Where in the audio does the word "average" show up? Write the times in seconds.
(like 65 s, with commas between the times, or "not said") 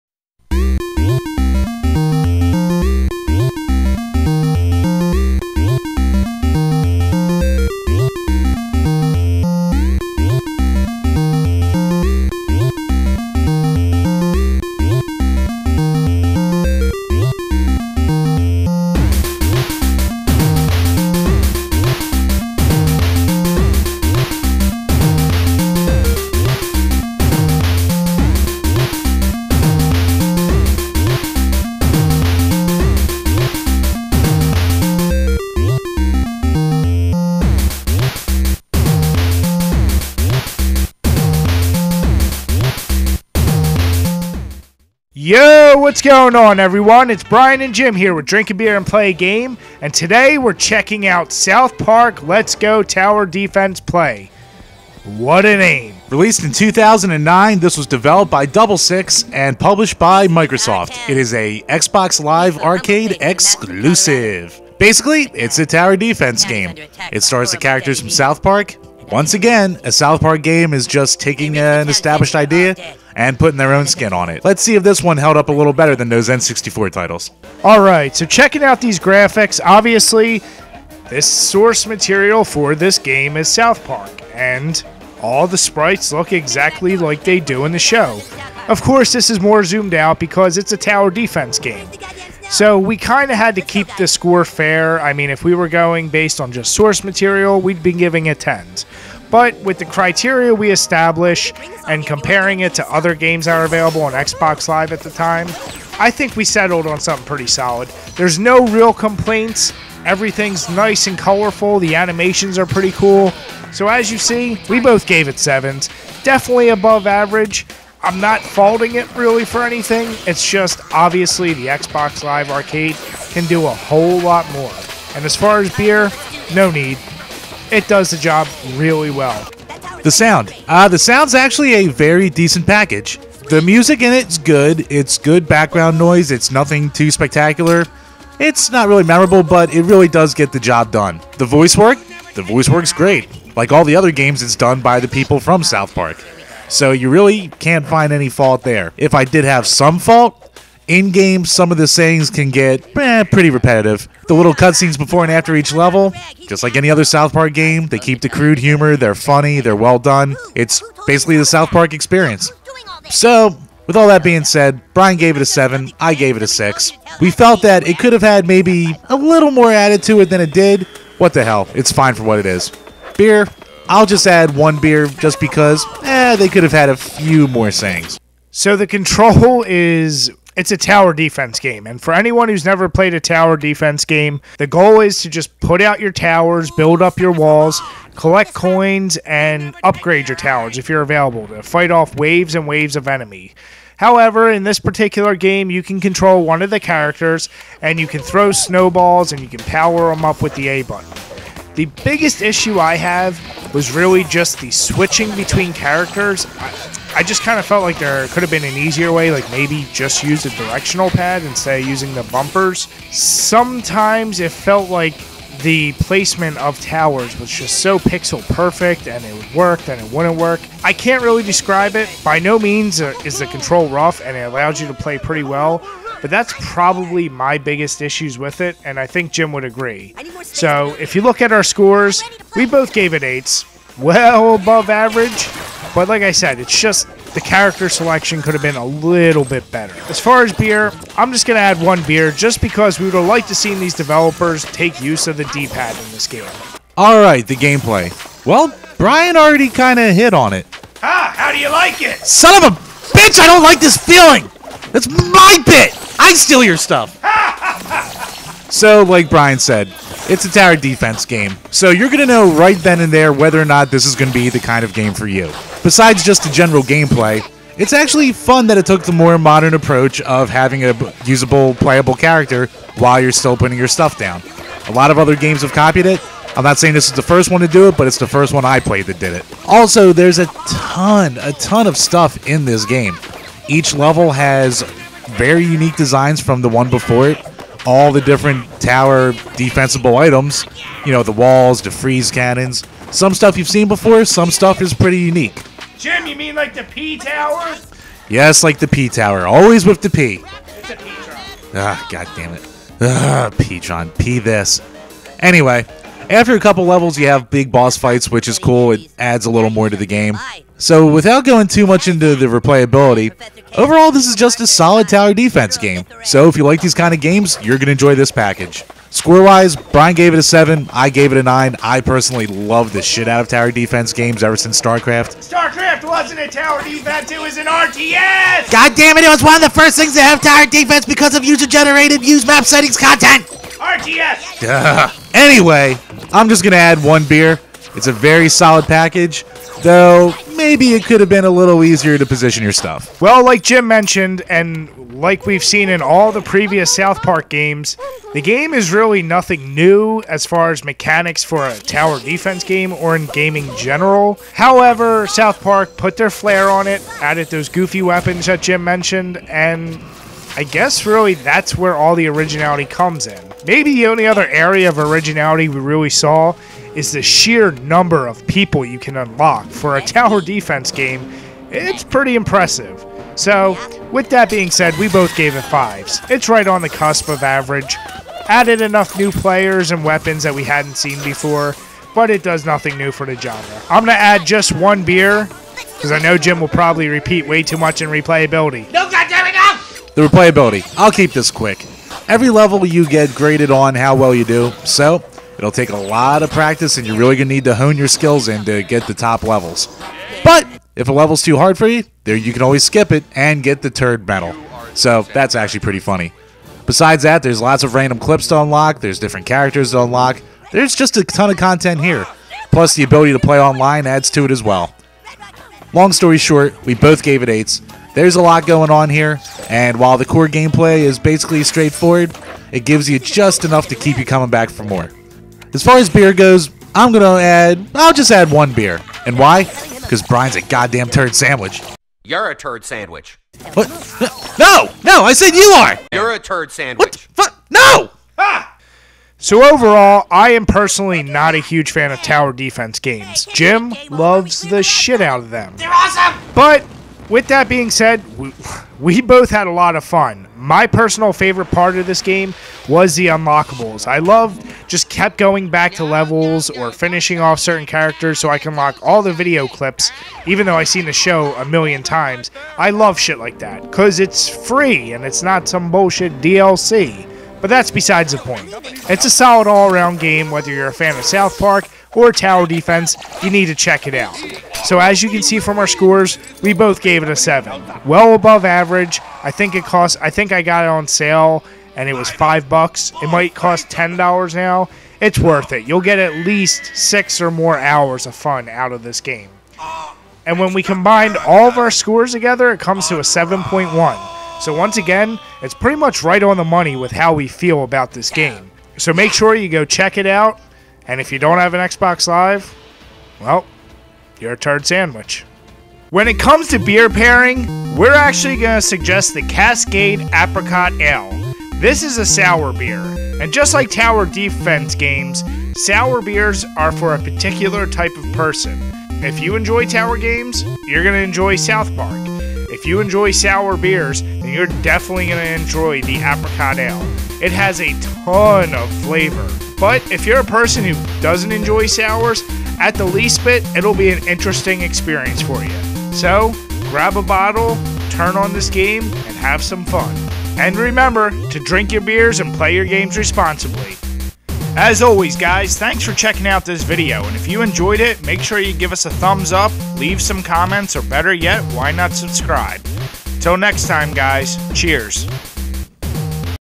117 s, 234 s, 377 s, 478 s.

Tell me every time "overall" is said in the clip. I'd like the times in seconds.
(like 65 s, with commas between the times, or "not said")
313 s, 439 s.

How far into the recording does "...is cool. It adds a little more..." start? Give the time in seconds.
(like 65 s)
308 s.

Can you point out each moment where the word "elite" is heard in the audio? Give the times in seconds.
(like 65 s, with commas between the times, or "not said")
not said.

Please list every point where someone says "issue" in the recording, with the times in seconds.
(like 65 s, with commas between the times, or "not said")
202 s, 228 s.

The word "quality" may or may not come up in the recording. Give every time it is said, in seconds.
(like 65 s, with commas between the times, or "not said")
not said.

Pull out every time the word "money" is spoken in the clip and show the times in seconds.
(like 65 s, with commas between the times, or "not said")
496 s.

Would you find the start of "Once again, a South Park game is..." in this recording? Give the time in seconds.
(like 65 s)
69 s.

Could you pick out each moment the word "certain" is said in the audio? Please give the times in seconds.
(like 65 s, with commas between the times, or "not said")
457 s.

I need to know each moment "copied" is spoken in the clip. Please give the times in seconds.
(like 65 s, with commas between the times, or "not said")
275 s.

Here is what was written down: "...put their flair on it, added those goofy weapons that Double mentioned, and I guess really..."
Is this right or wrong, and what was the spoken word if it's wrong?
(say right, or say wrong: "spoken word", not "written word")
wrong: "Jim", not "Double".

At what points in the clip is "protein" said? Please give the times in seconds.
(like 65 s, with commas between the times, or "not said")
not said.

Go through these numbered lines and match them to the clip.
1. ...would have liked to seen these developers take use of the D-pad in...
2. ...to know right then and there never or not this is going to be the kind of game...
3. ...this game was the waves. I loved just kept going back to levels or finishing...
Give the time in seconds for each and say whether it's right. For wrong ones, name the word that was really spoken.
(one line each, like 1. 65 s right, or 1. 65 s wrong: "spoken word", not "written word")
1. 243 s right
2. 262 s wrong: "whether", not "never"
3. 452 s wrong: "unlockables", not "waves".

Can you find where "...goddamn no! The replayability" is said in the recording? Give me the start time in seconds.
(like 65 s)
389 s.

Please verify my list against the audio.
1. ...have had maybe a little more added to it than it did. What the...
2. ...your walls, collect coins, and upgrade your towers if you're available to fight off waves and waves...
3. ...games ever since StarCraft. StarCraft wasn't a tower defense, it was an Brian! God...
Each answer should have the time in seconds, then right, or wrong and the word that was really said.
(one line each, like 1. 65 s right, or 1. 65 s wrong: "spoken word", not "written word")
1. 168 s right
2. 187 s right
3. 324 s wrong: "RTS", not "Brian".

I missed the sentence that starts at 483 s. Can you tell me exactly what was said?
It might cost ten dollars now.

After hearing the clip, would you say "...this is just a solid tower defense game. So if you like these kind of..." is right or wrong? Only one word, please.
right.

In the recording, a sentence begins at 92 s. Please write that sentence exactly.
So we kind of had to keep the score fair.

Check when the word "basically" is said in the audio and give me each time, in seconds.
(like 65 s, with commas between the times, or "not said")
64 s, 161 s, 421 s.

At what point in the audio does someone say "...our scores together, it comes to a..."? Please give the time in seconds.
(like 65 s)
491 s.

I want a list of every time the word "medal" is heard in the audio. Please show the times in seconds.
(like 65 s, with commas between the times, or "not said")
404 s.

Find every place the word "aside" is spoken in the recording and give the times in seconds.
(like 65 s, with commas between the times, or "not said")
not said.